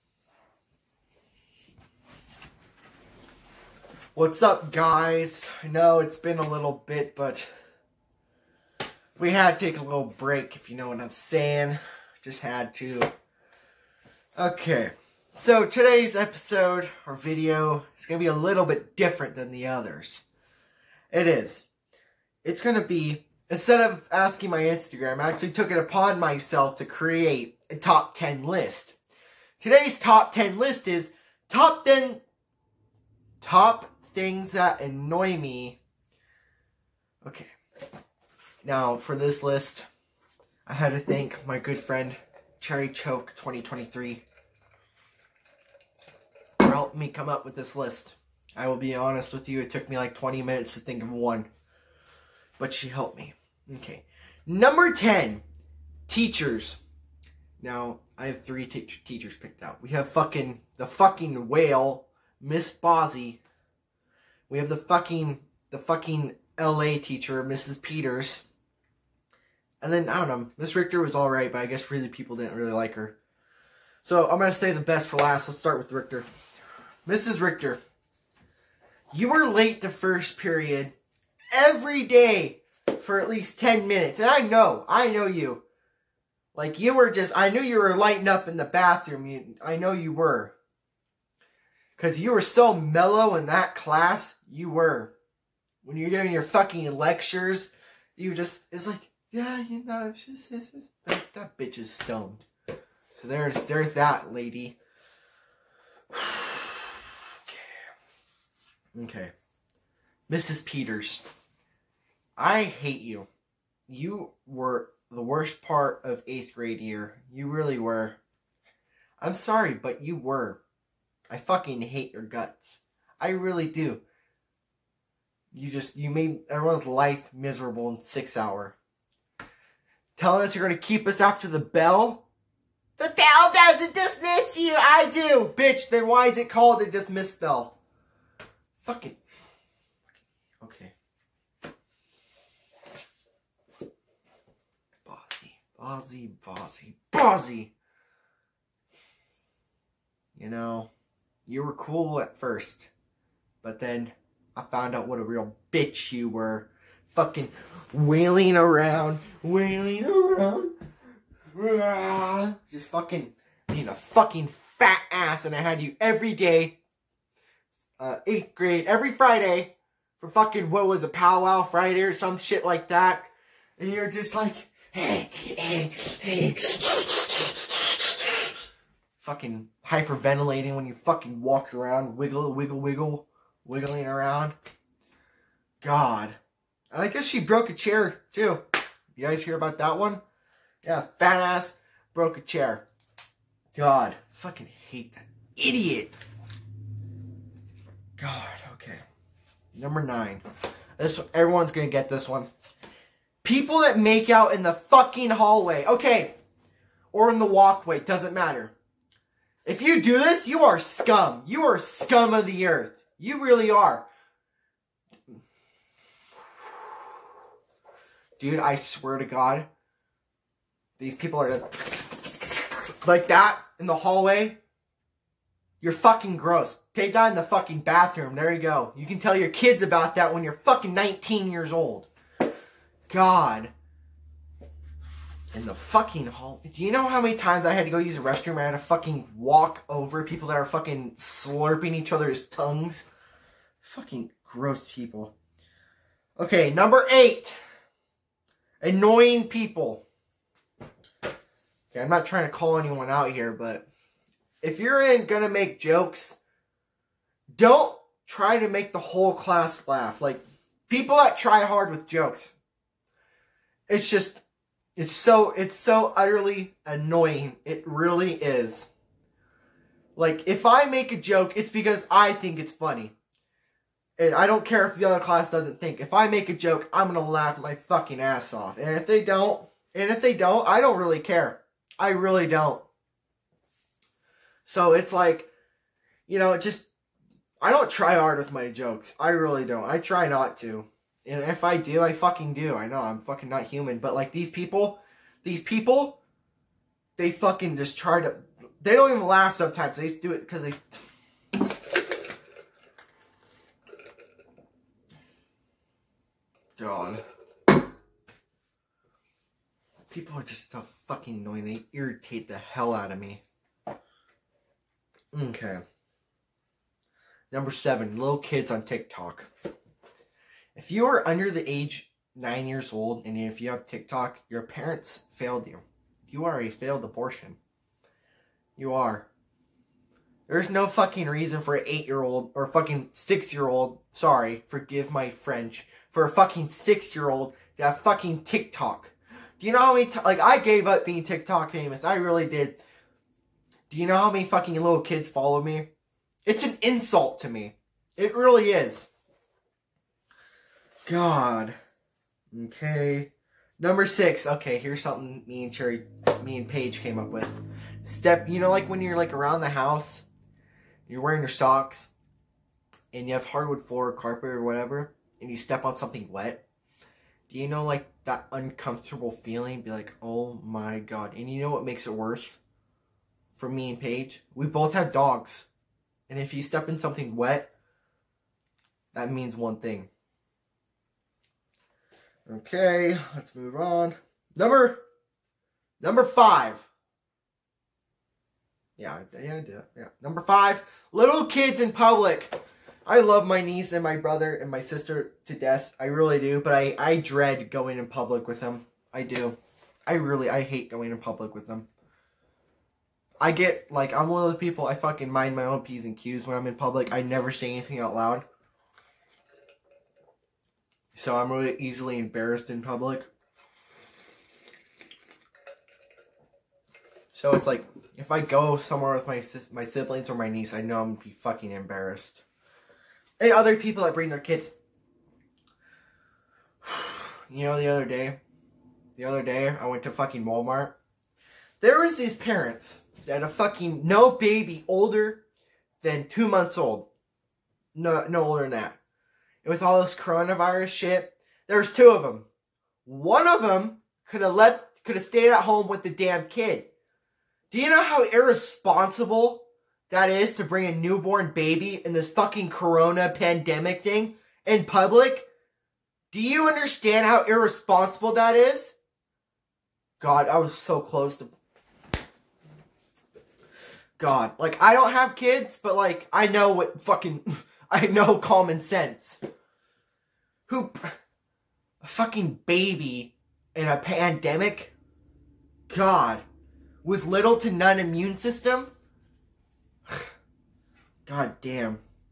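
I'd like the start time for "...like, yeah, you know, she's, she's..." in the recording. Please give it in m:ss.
1:38.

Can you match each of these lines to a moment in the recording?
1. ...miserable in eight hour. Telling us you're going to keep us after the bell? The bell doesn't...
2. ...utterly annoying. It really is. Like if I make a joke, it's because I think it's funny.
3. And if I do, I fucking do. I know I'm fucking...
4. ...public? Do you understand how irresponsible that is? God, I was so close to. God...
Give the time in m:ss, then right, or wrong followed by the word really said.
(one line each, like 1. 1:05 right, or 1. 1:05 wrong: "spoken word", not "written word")
1. 2:07 wrong: "six", not "eight"
2. 4:26 right
3. 4:51 right
4. 7:34 right.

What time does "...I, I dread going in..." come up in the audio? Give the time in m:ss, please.
6:36.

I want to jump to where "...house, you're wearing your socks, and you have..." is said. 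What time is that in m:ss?
5:59.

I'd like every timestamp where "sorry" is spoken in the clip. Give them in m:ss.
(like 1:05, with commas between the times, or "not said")
1:59, 5:34.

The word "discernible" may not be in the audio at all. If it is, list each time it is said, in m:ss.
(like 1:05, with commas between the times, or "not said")
not said.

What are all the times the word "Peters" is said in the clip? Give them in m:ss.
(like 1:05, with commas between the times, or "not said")
1:07, 1:50.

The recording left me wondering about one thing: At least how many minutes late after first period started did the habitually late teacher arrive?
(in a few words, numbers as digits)
10.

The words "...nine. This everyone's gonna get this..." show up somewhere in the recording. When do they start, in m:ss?
3:20.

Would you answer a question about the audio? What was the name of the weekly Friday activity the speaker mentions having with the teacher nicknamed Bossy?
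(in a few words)
Powwow Friday.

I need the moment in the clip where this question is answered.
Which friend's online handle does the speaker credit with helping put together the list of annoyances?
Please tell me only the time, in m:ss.
0:42.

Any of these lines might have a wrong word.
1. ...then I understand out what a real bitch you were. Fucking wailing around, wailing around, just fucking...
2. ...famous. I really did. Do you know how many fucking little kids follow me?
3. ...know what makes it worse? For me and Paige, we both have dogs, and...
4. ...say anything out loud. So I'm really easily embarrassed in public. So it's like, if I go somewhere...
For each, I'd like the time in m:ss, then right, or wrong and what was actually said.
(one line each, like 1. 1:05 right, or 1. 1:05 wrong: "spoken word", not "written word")
1. 2:33 wrong: "found", not "understand"
2. 5:41 right
3. 6:11 right
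4. 6:47 right.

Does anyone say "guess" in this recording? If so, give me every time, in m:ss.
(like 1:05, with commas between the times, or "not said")
1:11, 3:07.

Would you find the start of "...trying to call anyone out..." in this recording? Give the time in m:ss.
4:12.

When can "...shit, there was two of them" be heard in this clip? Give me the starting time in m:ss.
7:20.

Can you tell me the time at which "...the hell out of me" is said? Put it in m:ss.
5:12.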